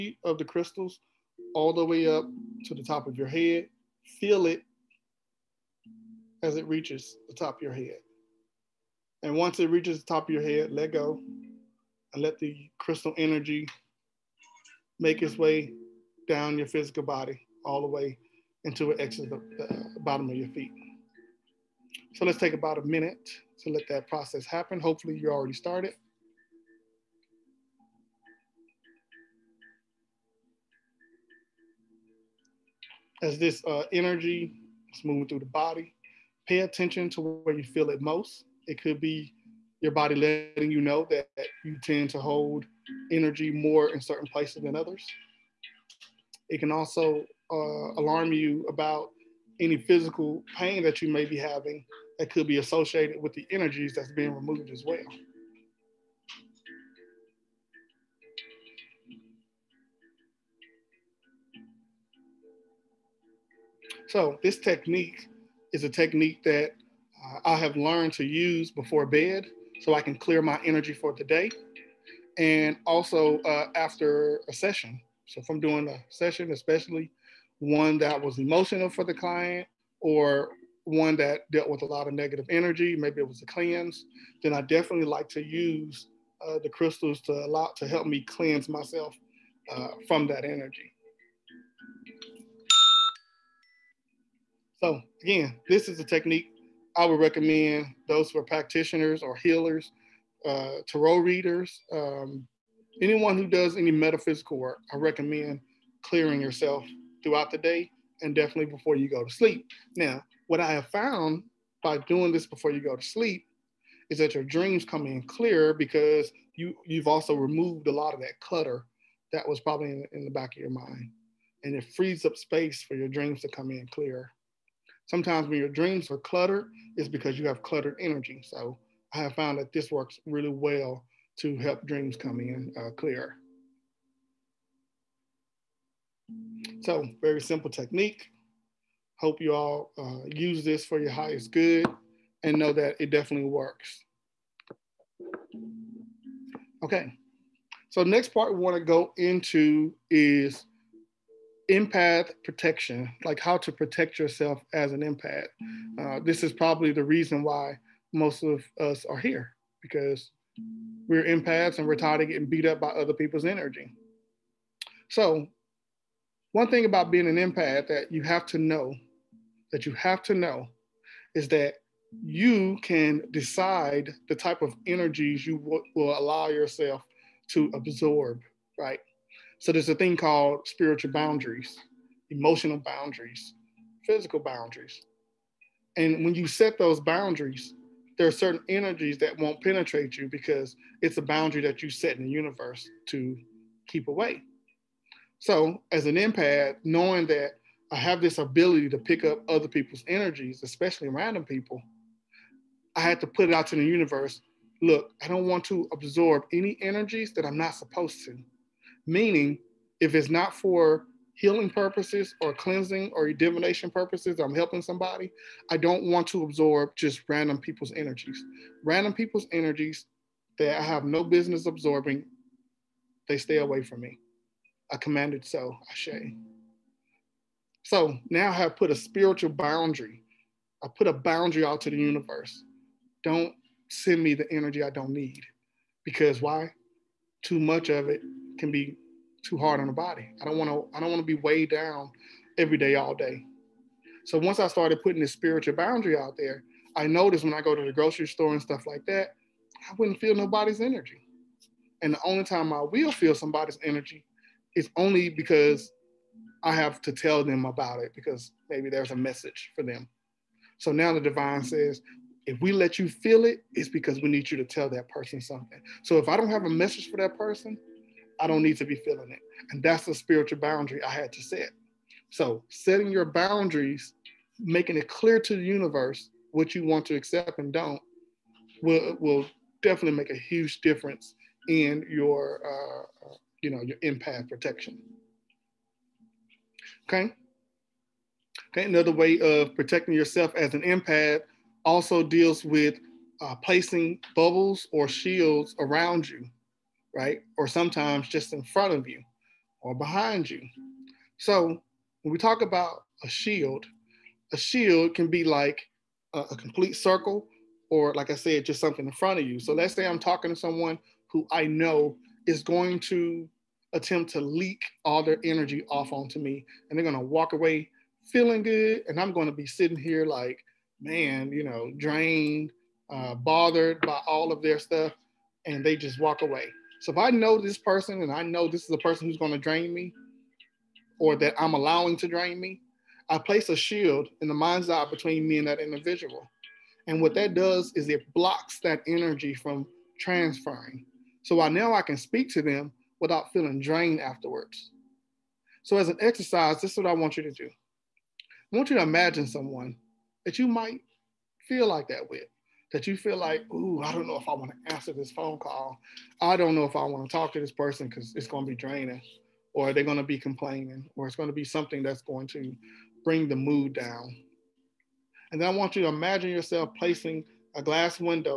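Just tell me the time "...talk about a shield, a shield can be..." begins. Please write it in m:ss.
5:02.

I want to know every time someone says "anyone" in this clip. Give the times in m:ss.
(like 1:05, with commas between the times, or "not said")
1:42.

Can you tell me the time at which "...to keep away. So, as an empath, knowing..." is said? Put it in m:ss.
3:13.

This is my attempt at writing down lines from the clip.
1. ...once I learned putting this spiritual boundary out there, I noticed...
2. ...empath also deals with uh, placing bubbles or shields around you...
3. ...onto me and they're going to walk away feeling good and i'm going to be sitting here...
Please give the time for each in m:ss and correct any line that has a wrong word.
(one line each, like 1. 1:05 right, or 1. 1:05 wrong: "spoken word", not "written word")
1. 4:04 wrong: "started", not "learned"
2. 4:50 right
3. 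5:16 right.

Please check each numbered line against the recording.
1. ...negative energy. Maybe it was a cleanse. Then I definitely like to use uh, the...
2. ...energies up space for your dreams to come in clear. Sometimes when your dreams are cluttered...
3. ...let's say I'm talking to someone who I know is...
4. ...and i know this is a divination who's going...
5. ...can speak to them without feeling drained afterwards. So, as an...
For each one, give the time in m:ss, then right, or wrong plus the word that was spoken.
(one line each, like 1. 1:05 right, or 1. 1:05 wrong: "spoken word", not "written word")
1. 1:22 right
2. 2:01 wrong: "frees", not "energies"
3. 5:09 right
4. 5:28 wrong: "person", not "divination"
5. 5:42 right.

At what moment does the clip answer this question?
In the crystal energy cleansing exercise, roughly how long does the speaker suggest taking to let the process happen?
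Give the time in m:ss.
0:22.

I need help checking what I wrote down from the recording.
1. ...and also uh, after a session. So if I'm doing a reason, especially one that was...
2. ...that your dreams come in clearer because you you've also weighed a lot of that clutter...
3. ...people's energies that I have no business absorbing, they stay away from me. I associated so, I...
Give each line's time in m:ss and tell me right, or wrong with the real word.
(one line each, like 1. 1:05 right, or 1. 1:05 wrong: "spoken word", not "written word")
1. 1:12 wrong: "session", not "reason"
2. 1:54 wrong: "removed", not "weighed"
3. 3:39 wrong: "commanded", not "associated".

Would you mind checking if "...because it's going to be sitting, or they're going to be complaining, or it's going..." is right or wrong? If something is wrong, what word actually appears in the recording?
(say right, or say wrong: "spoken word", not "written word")
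wrong: "draining", not "sitting".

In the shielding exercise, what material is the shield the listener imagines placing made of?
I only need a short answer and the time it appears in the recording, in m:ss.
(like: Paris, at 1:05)
glass, at 6:07.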